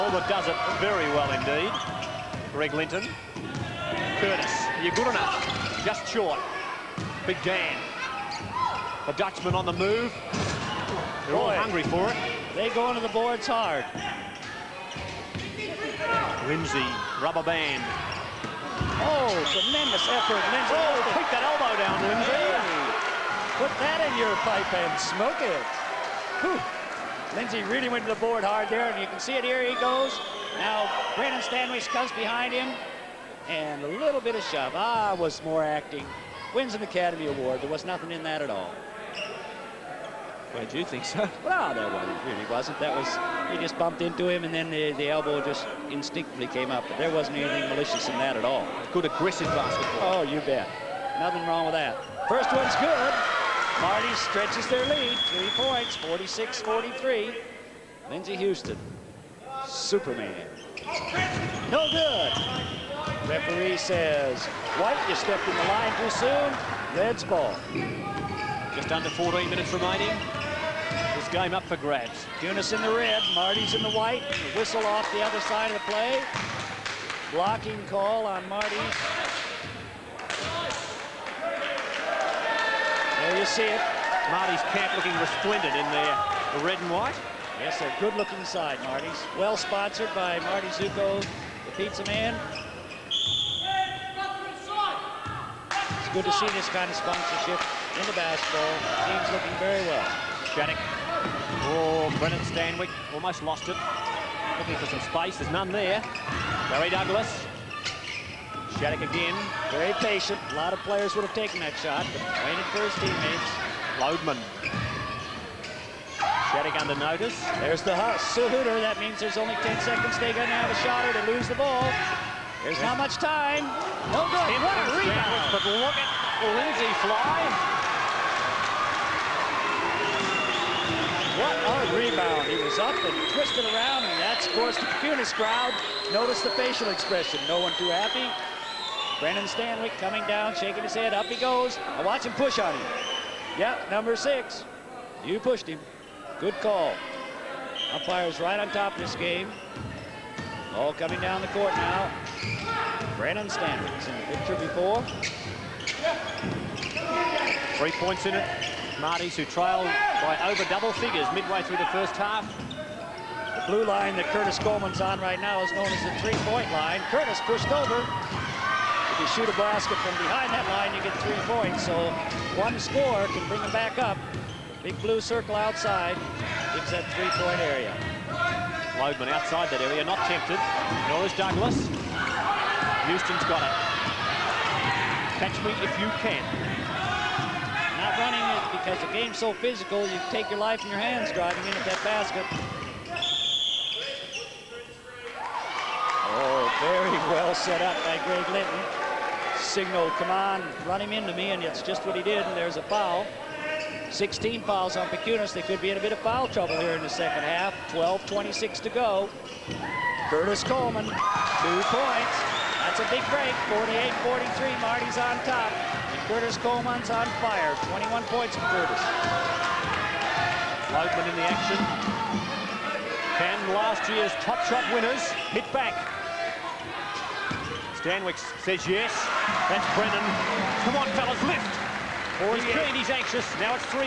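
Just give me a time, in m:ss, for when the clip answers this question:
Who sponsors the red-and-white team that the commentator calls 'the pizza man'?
1:30.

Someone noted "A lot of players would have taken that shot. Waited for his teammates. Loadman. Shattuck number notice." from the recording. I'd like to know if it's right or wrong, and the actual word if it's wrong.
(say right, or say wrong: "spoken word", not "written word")
wrong: "under", not "number".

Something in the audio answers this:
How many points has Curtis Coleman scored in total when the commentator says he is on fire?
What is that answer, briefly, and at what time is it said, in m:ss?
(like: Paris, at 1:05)
21, at 3:37.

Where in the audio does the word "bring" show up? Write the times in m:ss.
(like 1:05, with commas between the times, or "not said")
2:53.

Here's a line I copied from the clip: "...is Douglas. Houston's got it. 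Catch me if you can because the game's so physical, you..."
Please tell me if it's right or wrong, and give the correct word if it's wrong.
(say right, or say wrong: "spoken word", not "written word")
right.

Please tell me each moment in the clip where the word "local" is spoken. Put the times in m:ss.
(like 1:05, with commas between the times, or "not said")
not said.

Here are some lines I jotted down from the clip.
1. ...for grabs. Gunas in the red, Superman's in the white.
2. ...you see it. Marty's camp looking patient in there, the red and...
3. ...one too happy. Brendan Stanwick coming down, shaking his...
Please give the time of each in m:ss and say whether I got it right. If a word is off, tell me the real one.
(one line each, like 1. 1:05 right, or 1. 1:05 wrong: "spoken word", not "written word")
1. 1:11 wrong: "Marty", not "Superman"
2. 1:23 wrong: "resplendent", not "patient"
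3. 2:17 right.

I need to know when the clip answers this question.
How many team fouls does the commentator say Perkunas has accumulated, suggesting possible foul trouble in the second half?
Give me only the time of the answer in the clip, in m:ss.
3:24.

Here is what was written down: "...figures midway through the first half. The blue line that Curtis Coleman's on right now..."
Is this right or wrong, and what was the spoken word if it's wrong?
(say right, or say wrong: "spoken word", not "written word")
right.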